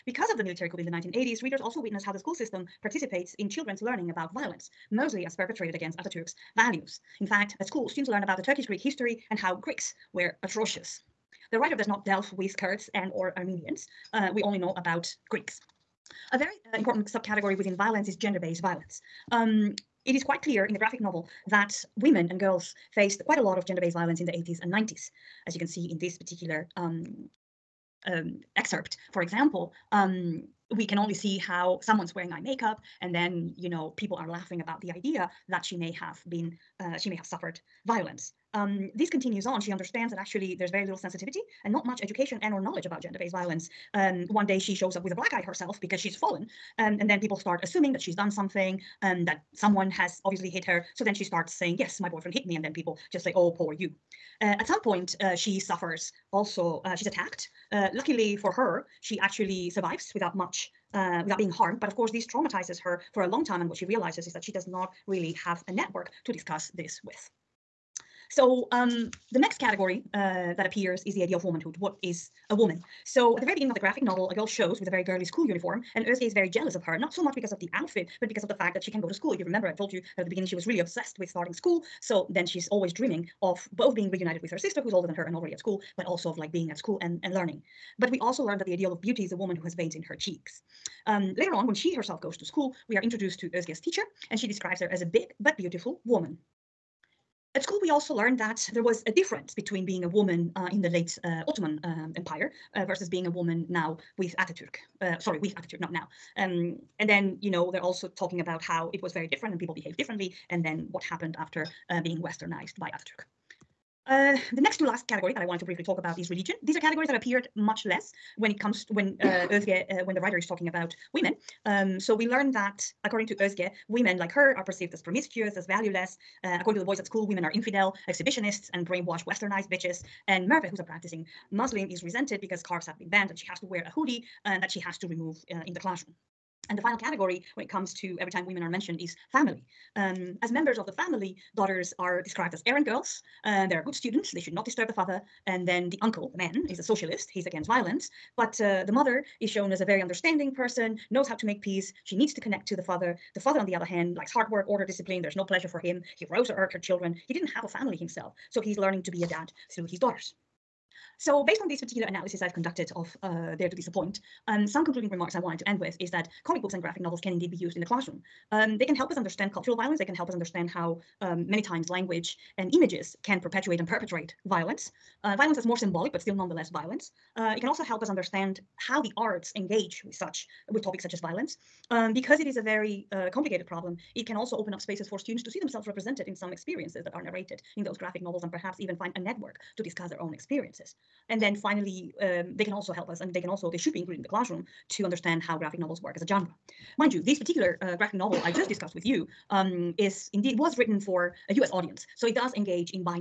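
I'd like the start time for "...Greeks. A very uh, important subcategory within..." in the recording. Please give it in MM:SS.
00:15.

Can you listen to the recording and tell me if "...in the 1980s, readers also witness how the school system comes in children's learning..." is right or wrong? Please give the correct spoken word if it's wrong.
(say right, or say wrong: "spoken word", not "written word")
wrong: "participates", not "comes".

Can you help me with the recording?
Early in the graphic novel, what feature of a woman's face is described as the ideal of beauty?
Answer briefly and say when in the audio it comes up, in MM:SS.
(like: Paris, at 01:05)
Veins in her cheeks, at 01:29.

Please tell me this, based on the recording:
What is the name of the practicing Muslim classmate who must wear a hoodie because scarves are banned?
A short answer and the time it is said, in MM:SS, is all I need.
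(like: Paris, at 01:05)
Merve, at 02:10.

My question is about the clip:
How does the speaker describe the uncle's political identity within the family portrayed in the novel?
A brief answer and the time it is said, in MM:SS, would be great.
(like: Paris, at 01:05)
Socialist, at 02:26.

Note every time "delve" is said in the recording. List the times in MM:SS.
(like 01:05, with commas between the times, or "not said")
00:12.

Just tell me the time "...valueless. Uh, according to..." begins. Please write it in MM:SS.
02:05.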